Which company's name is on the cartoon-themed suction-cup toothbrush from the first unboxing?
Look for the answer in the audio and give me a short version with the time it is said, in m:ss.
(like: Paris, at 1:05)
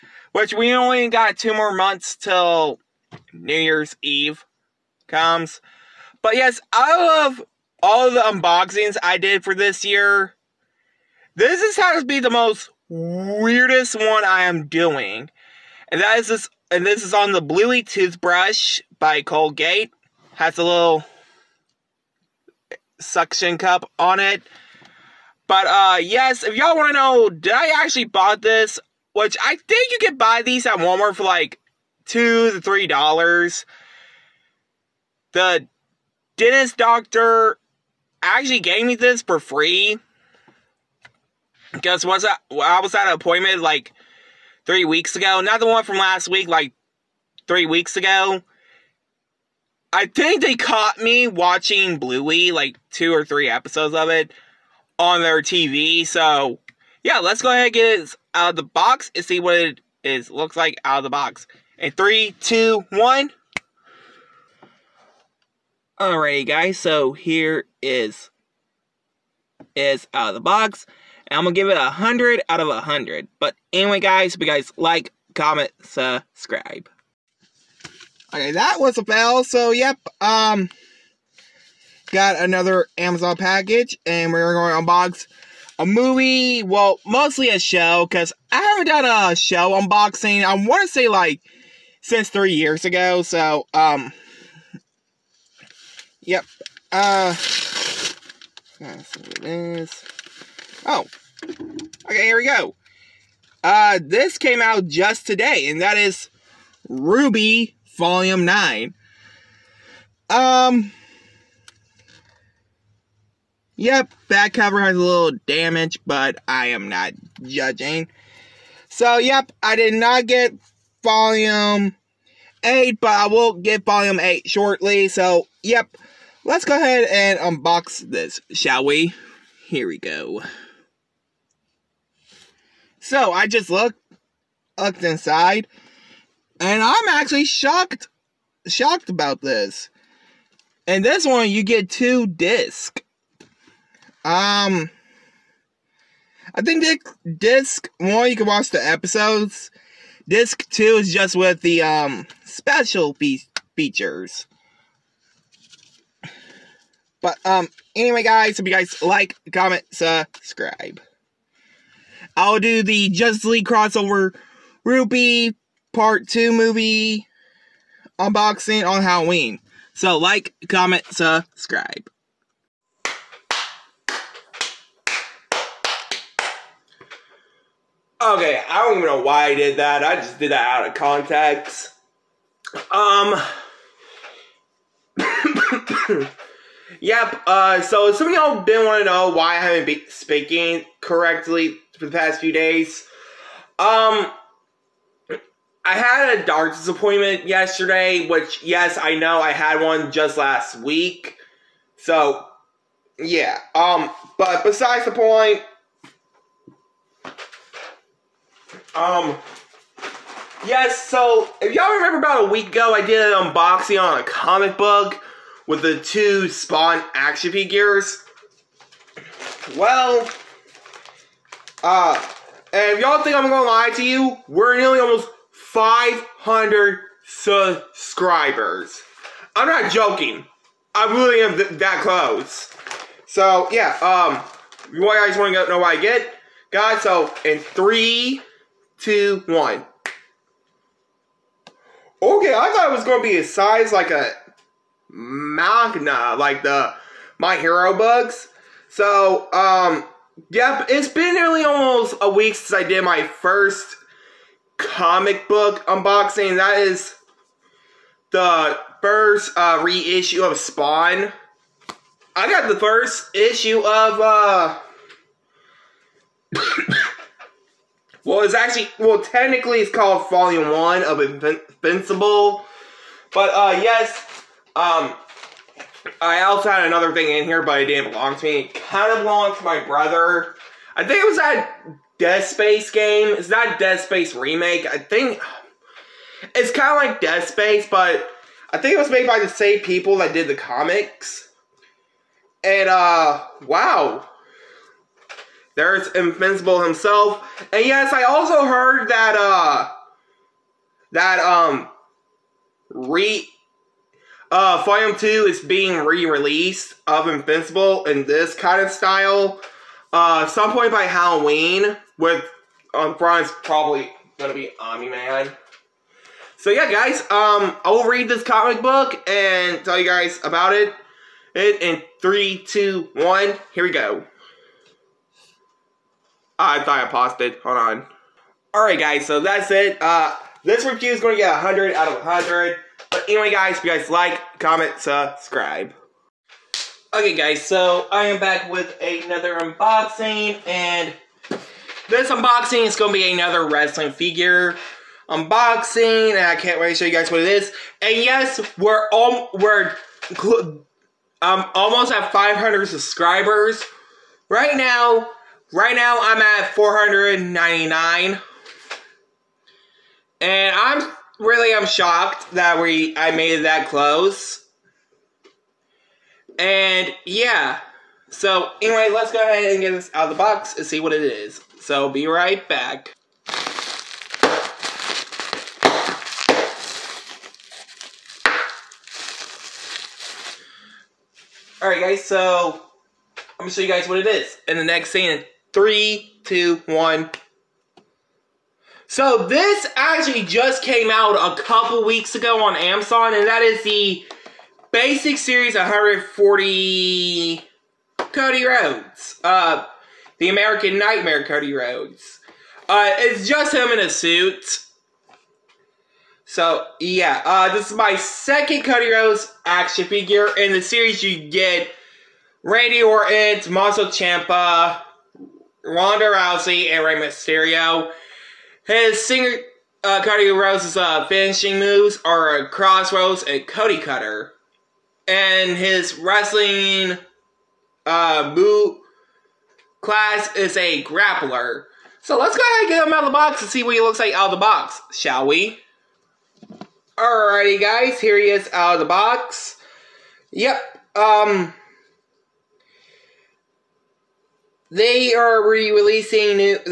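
Colgate, at 0:19.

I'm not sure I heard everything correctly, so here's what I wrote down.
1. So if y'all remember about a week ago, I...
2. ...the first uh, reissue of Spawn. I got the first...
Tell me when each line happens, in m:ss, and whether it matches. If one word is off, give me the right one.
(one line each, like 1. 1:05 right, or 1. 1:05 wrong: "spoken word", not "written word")
1. 3:31 right
2. 4:18 right.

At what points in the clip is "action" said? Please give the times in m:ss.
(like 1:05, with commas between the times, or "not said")
3:37, 6:49.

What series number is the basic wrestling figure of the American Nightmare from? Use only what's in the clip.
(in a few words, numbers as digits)
140.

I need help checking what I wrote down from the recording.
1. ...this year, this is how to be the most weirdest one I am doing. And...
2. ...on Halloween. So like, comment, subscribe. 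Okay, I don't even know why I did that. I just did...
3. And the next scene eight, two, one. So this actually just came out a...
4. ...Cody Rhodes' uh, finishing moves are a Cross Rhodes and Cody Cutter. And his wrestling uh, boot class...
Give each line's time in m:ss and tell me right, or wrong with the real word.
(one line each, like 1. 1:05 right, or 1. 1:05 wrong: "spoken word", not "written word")
1. 0:09 right
2. 2:48 right
3. 6:24 wrong: "three", not "eight"
4. 7:00 right.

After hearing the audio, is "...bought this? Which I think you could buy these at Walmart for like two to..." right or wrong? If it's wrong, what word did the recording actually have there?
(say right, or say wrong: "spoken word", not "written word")
right.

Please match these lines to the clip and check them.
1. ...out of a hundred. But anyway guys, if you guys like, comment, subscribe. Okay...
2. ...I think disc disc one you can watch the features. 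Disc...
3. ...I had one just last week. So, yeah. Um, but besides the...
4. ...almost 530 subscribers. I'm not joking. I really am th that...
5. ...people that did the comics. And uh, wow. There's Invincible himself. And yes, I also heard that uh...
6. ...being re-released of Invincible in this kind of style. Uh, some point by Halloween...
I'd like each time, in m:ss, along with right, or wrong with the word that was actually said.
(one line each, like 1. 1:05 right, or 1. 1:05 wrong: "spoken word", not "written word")
1. 1:12 right
2. 2:26 wrong: "episodes", not "features"
3. 3:19 right
4. 3:44 wrong: "500", not "530"
5. 4:49 right
6. 5:05 right.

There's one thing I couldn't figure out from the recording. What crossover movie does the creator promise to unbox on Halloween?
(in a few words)
Justice League crossover RWBY Part 2.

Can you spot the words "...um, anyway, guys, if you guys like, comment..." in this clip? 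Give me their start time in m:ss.
2:37.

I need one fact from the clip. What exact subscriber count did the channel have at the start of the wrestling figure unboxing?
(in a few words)
499.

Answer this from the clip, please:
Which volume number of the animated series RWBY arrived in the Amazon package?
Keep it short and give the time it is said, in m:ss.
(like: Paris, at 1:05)
9, at 1:47.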